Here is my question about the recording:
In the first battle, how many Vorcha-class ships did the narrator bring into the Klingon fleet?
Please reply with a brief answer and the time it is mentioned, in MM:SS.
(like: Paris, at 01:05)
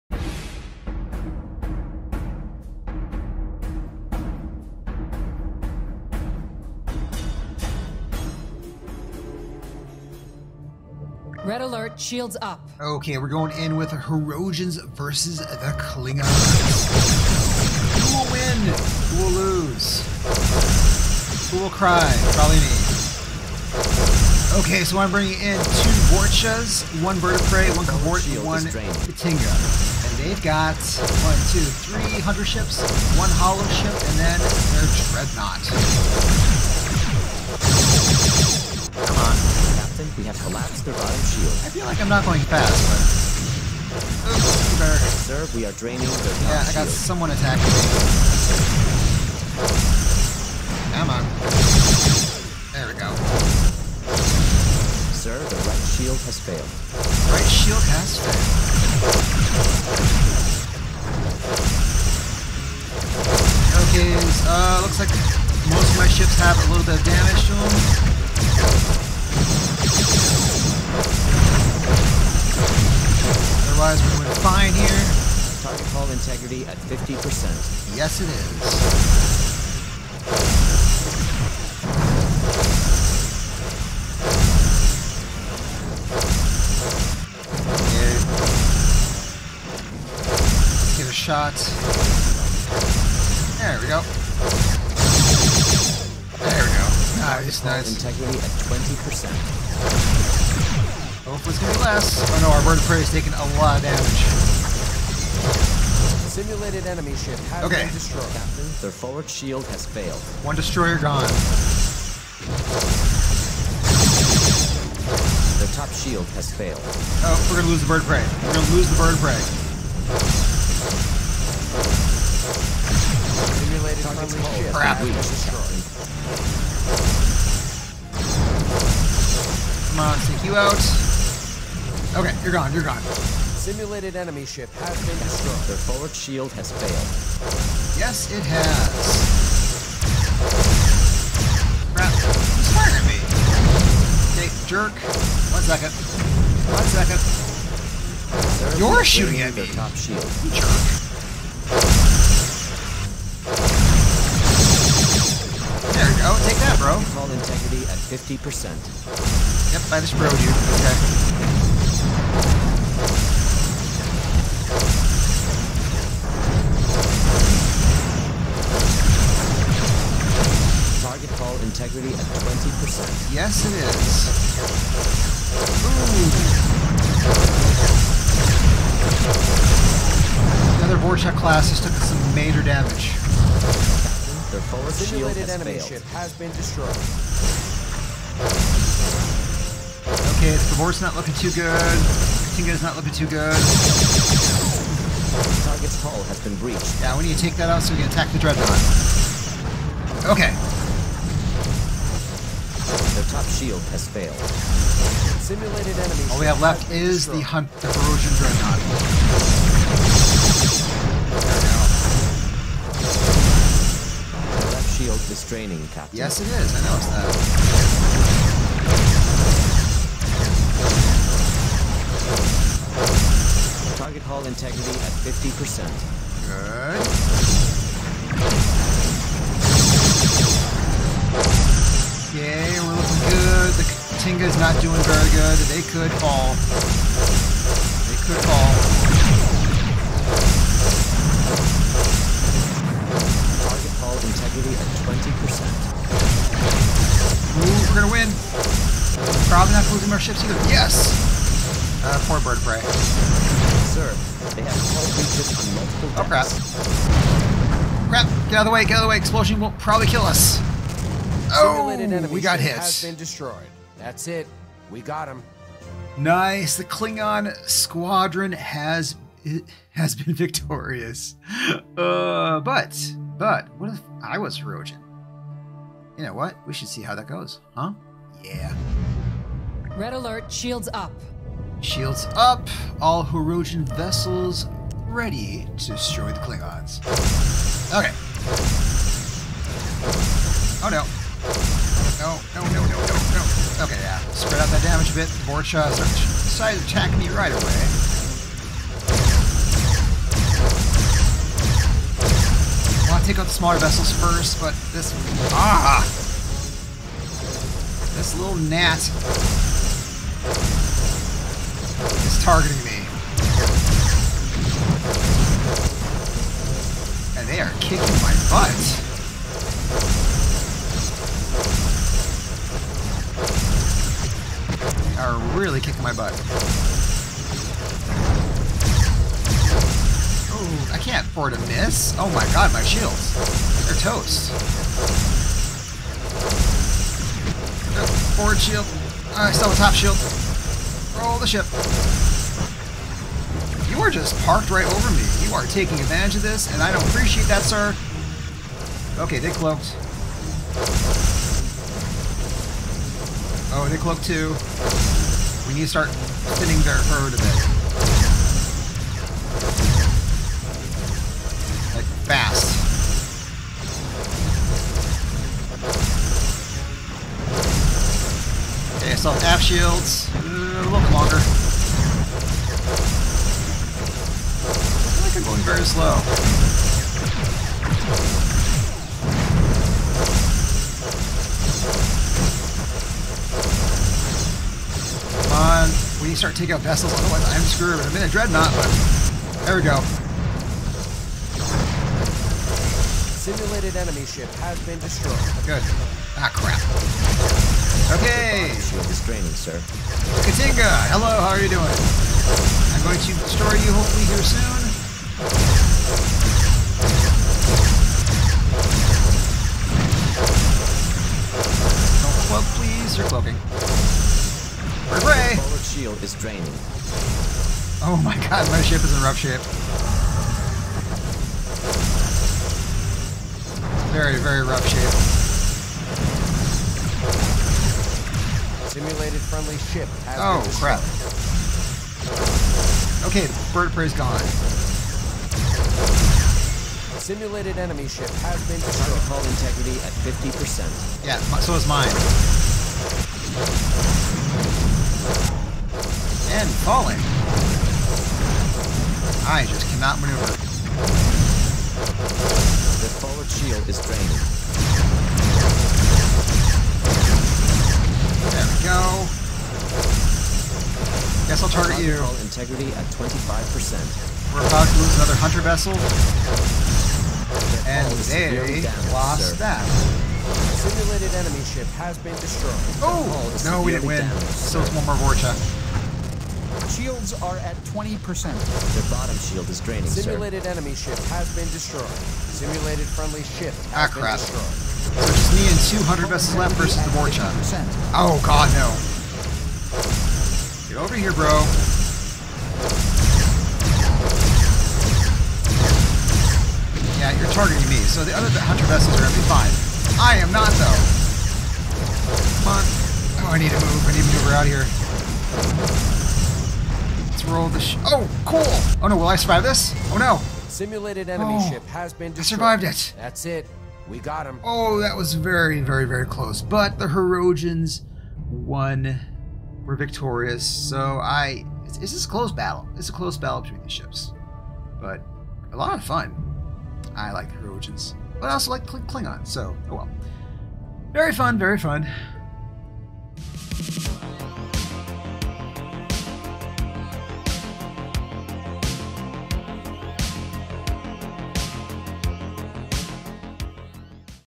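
2, at 00:25.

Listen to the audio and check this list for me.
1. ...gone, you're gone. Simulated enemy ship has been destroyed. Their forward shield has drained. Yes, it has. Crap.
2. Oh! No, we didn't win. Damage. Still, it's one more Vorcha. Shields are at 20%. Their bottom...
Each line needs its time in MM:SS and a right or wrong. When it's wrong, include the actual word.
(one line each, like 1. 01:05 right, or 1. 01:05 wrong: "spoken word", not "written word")
1. 02:12 wrong: "failed", not "drained"
2. 07:53 right.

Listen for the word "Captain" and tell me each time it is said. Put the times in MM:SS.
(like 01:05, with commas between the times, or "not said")
01:48, 03:35.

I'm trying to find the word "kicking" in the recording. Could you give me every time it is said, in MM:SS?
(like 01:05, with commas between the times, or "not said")
05:17, 05:25.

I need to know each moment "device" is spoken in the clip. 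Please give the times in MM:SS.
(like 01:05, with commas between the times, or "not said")
not said.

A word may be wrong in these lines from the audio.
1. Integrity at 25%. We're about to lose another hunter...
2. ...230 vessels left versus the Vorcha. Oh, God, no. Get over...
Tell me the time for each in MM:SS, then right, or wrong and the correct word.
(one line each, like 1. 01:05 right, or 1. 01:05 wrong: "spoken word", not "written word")
1. 07:42 right
2. 08:06 wrong: "200", not "230".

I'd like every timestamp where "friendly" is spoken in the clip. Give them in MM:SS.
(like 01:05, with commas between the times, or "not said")
02:04, 07:09, 08:03.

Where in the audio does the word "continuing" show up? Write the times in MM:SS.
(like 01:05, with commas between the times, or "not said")
not said.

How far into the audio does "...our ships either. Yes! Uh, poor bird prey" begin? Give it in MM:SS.
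04:10.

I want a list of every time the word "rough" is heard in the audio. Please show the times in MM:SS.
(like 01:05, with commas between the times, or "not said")
06:59, 07:04.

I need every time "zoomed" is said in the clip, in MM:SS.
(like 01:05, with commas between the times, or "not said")
not said.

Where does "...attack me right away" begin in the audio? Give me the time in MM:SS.
04:56.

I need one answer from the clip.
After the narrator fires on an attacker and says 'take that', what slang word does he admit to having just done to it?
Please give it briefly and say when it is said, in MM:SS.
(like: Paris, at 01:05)
broed, at 02:40.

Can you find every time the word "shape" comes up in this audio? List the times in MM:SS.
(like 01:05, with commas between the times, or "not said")
06:59, 07:04.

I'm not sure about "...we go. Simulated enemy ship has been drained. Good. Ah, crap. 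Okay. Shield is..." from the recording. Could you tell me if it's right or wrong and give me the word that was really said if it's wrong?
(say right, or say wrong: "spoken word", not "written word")
wrong: "destroyed", not "drained".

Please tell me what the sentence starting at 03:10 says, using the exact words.
Okay, the Vor's not looking too good.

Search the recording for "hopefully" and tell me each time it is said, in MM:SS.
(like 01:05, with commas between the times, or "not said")
01:41, 06:43.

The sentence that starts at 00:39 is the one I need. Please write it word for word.
Come on we have collapsed their bottom shield.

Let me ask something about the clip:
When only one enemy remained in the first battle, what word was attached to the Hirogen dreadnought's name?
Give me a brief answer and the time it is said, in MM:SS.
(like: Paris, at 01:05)
corrosion, at 03:27.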